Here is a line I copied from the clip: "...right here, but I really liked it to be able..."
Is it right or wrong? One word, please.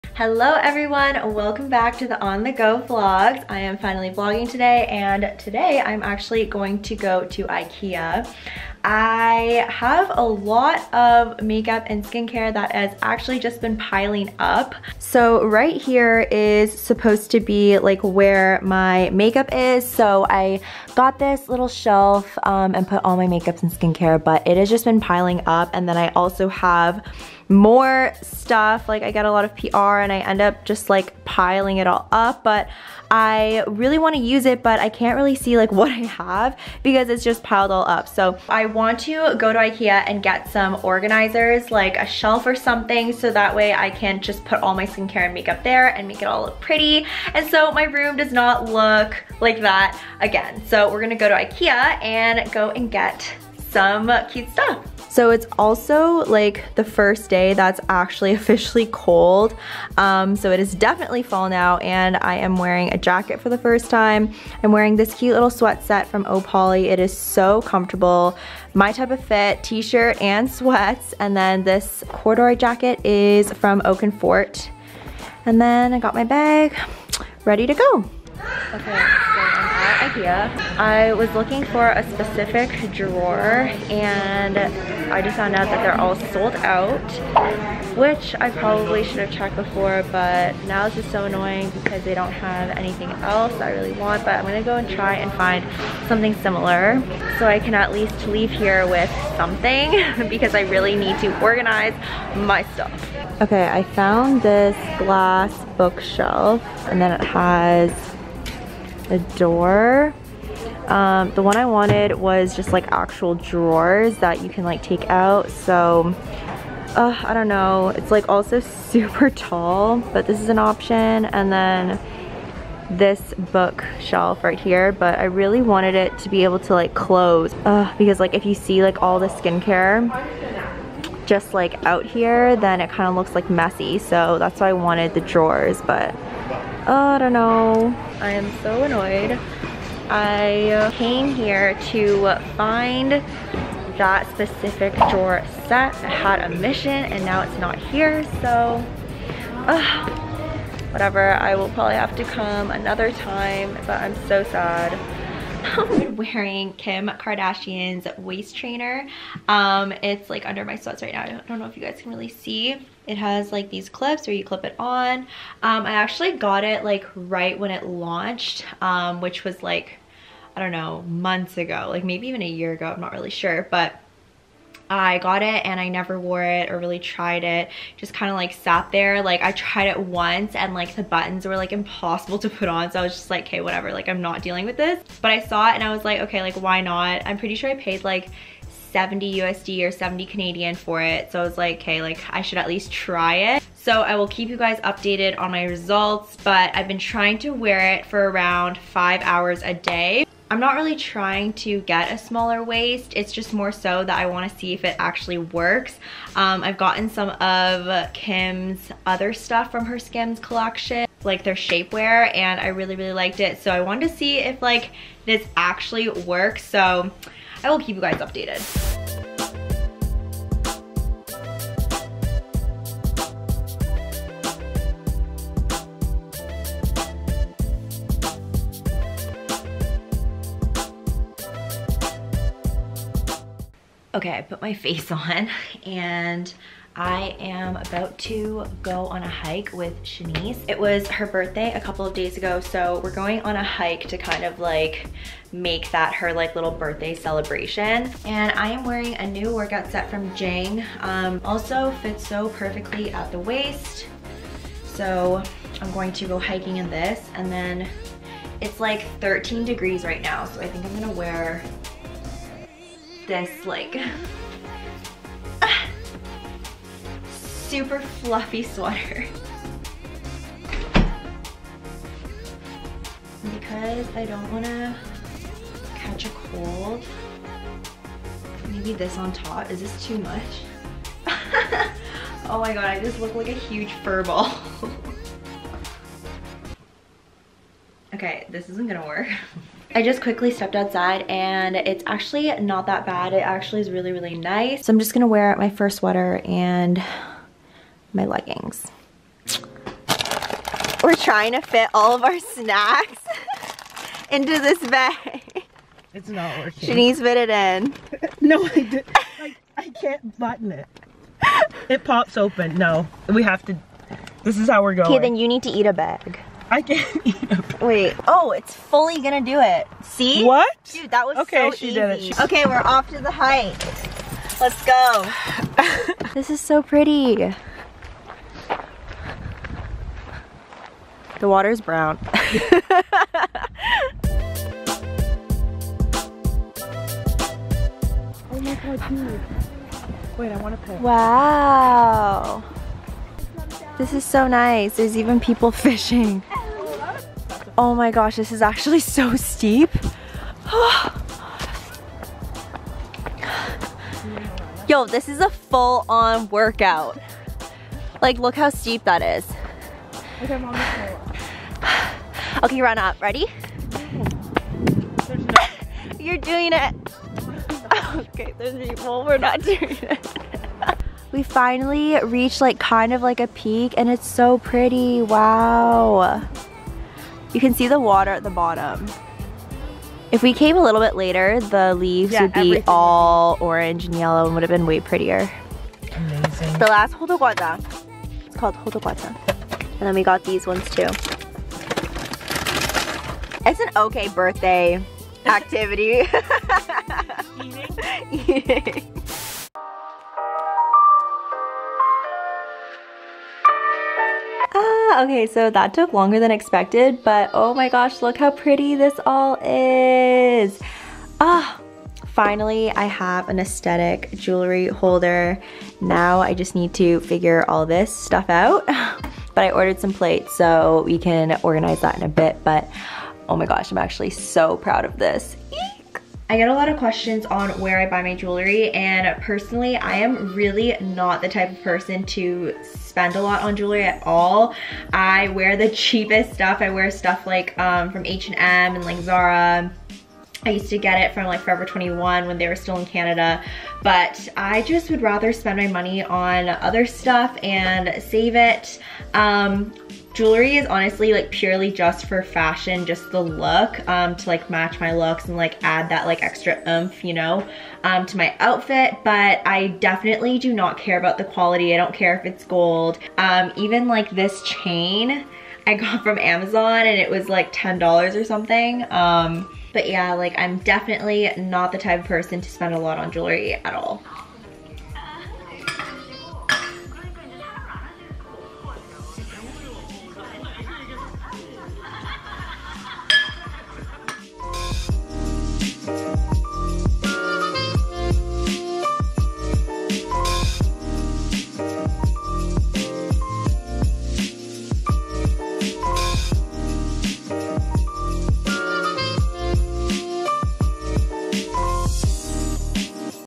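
wrong.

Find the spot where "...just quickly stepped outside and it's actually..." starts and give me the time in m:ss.
4:50.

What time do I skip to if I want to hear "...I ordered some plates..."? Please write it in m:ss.
6:59.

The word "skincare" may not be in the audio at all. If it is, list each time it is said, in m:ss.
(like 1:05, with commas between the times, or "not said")
0:12, 0:23, 0:44, 2:09.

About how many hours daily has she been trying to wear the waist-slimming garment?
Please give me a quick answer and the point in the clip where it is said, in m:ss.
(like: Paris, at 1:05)
5, at 3:18.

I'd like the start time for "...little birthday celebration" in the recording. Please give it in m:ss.
4:06.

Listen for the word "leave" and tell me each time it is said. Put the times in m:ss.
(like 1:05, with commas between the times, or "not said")
1:38, 6:21.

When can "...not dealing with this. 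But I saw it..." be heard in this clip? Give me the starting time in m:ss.
3:04.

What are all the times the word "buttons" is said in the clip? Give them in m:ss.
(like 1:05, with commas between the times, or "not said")
3:01, 5:10.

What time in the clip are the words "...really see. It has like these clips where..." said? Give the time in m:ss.
2:42.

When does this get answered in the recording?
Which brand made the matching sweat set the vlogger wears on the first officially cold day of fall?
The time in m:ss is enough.
1:06.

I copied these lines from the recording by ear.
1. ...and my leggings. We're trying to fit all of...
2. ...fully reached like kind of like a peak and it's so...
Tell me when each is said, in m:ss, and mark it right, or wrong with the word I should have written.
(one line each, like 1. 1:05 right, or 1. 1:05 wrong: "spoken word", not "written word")
1. 4:56 right
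2. 6:11 wrong: "finally", not "fully".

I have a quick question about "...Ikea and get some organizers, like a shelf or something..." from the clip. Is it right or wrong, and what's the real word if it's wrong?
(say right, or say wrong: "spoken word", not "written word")
right.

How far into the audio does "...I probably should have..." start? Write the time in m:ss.
1:28.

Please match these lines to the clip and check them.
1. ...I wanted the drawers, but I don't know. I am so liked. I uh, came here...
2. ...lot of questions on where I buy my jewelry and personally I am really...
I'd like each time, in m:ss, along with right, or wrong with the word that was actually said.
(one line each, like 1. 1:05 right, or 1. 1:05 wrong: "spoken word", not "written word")
1. 2:14 wrong: "annoyed", not "liked"
2. 7:06 right.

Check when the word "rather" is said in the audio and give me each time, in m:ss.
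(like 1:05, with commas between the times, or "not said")
7:25.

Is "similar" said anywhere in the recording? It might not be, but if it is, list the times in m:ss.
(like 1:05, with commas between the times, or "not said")
1:36.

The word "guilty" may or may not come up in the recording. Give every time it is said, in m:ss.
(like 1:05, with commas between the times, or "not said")
not said.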